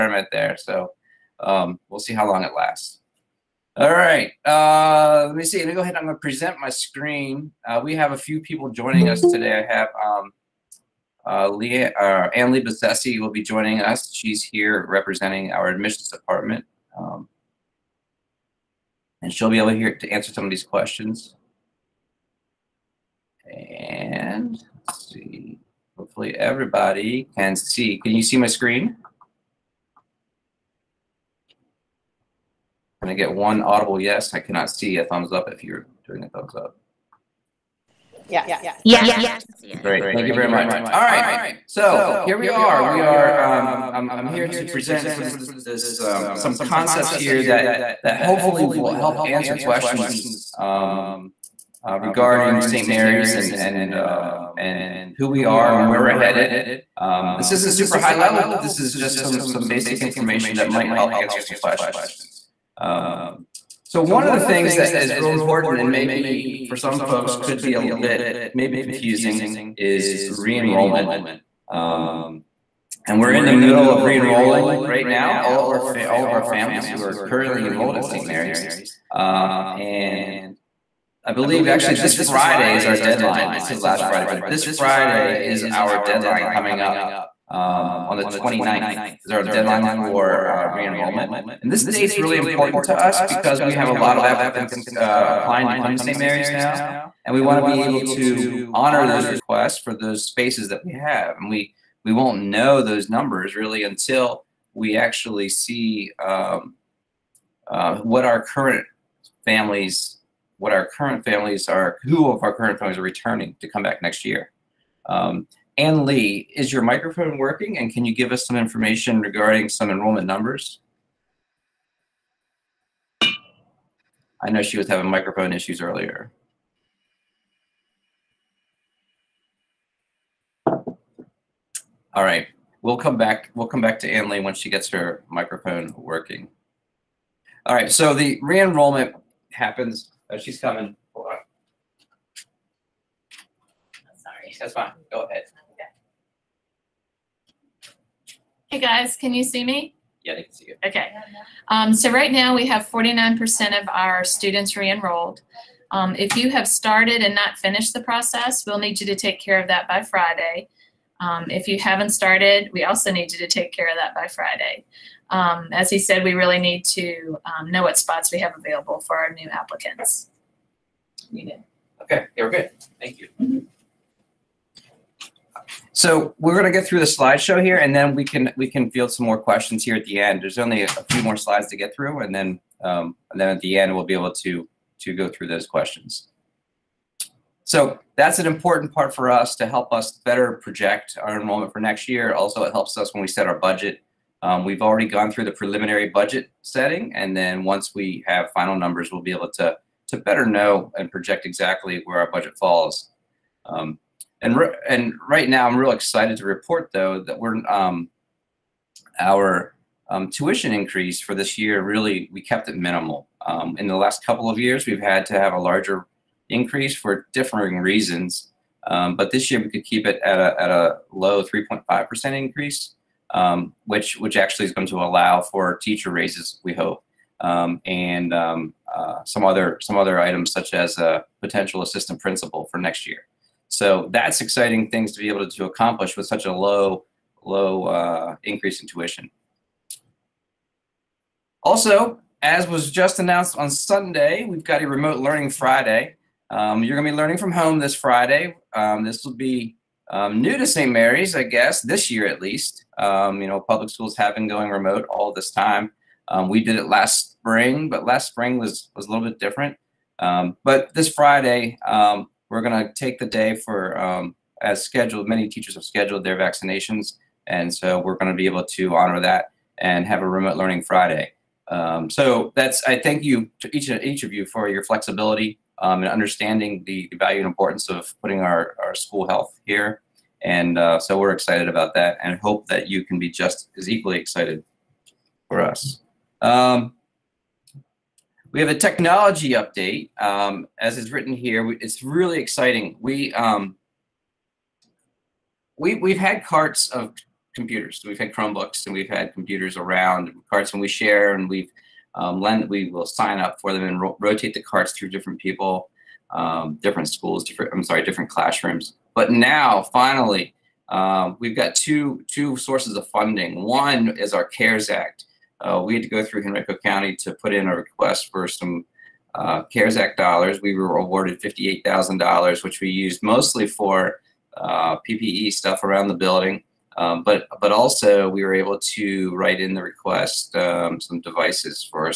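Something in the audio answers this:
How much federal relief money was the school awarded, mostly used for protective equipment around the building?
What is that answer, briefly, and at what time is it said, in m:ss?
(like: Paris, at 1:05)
$58,000, at 5:21.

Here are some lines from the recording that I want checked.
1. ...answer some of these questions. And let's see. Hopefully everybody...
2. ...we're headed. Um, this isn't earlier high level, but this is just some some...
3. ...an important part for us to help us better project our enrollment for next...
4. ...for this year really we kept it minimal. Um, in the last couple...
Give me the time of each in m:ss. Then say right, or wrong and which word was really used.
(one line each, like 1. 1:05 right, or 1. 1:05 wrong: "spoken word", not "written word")
1. 0:20 right
2. 0:56 wrong: "super", not "earlier"
3. 3:08 right
4. 3:31 right.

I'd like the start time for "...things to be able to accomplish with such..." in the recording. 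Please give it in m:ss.
3:54.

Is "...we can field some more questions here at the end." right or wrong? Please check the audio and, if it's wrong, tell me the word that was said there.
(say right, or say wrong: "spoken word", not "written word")
right.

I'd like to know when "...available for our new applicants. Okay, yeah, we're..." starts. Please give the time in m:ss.
2:48.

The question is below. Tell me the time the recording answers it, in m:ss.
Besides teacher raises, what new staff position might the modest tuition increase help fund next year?
3:51.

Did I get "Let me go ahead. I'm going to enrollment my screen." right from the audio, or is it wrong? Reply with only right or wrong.
wrong.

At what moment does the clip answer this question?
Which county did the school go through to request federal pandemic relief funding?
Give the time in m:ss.
5:16.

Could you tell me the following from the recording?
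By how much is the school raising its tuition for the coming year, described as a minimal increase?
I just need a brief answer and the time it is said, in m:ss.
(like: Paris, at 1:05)
3.5 percent, at 3:41.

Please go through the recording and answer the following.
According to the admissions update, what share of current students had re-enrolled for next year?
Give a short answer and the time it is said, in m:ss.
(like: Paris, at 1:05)
49%, at 2:32.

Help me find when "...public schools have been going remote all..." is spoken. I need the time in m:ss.
4:13.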